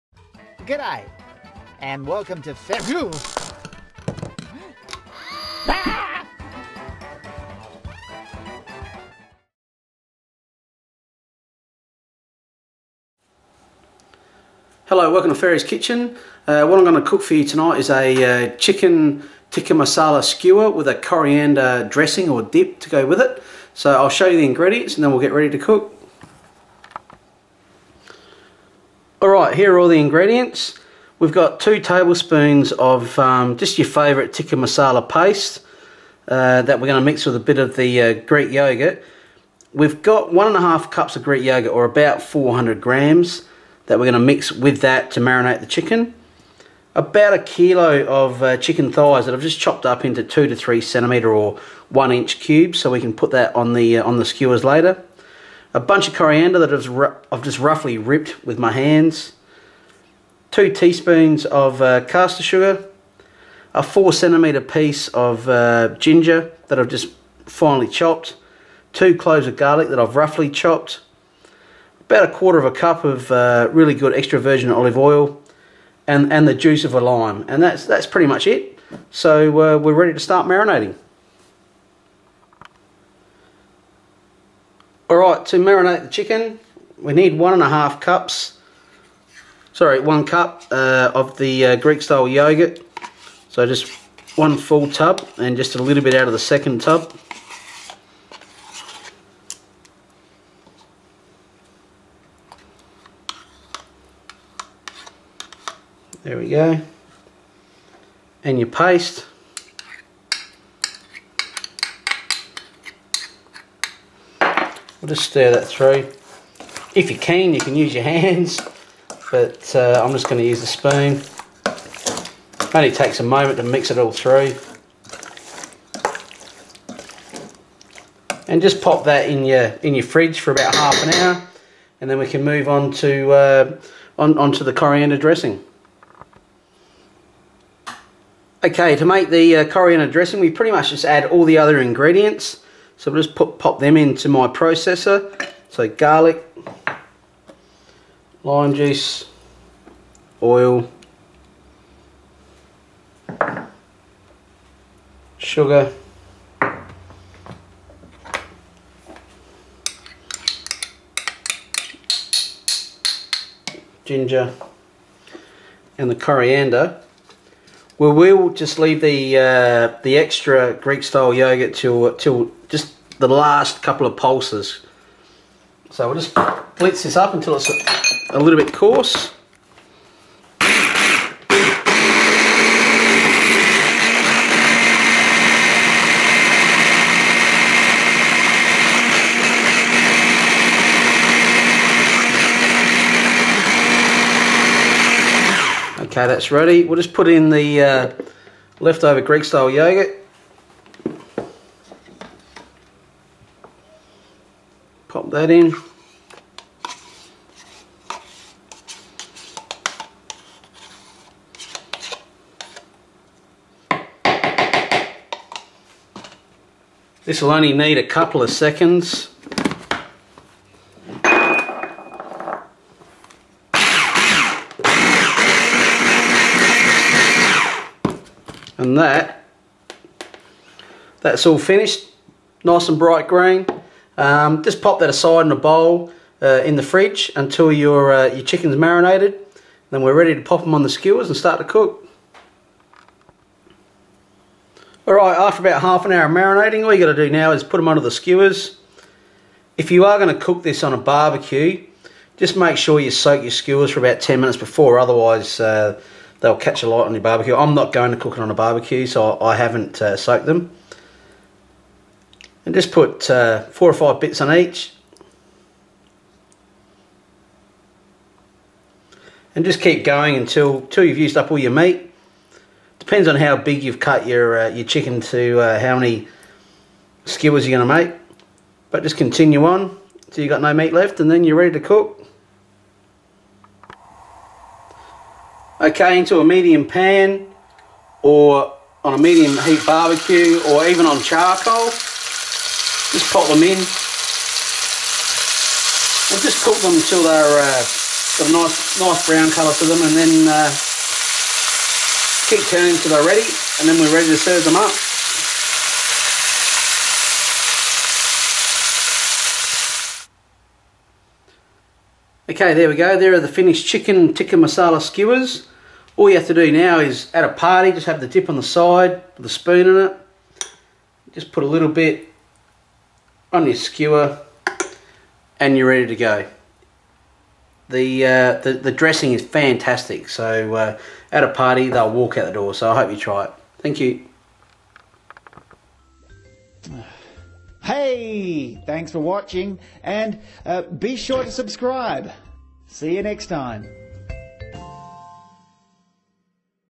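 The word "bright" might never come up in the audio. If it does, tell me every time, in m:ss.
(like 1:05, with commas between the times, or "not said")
3:52.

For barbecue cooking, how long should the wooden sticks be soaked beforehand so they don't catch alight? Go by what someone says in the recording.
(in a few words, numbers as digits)
10 minutes.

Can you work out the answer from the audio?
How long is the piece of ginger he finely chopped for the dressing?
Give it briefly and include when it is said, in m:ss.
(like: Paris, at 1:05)
4 centimetres, at 1:03.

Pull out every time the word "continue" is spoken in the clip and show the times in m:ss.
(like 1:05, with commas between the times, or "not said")
4:39.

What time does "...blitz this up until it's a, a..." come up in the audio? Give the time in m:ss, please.
2:56.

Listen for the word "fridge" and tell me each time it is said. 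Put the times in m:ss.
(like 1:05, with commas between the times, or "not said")
2:10, 3:56.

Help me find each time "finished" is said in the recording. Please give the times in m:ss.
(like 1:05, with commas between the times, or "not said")
3:51, 5:13.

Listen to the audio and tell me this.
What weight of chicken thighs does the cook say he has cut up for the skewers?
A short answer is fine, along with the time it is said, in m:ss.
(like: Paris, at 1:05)
1 kilo, at 0:46.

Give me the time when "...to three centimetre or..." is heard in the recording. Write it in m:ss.
0:50.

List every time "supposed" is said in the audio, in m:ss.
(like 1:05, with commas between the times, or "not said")
not said.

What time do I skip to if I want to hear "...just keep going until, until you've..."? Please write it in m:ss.
4:29.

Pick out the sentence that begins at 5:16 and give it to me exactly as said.
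All you have to do now is at a party, just have the dip on the side with a spoon in it.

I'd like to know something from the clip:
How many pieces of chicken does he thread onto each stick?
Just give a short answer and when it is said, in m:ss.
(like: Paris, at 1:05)
4 or 5, at 4:23.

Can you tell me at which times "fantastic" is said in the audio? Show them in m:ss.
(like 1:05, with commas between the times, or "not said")
5:29.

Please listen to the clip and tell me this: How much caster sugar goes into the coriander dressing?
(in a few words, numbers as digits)
2 teaspoons.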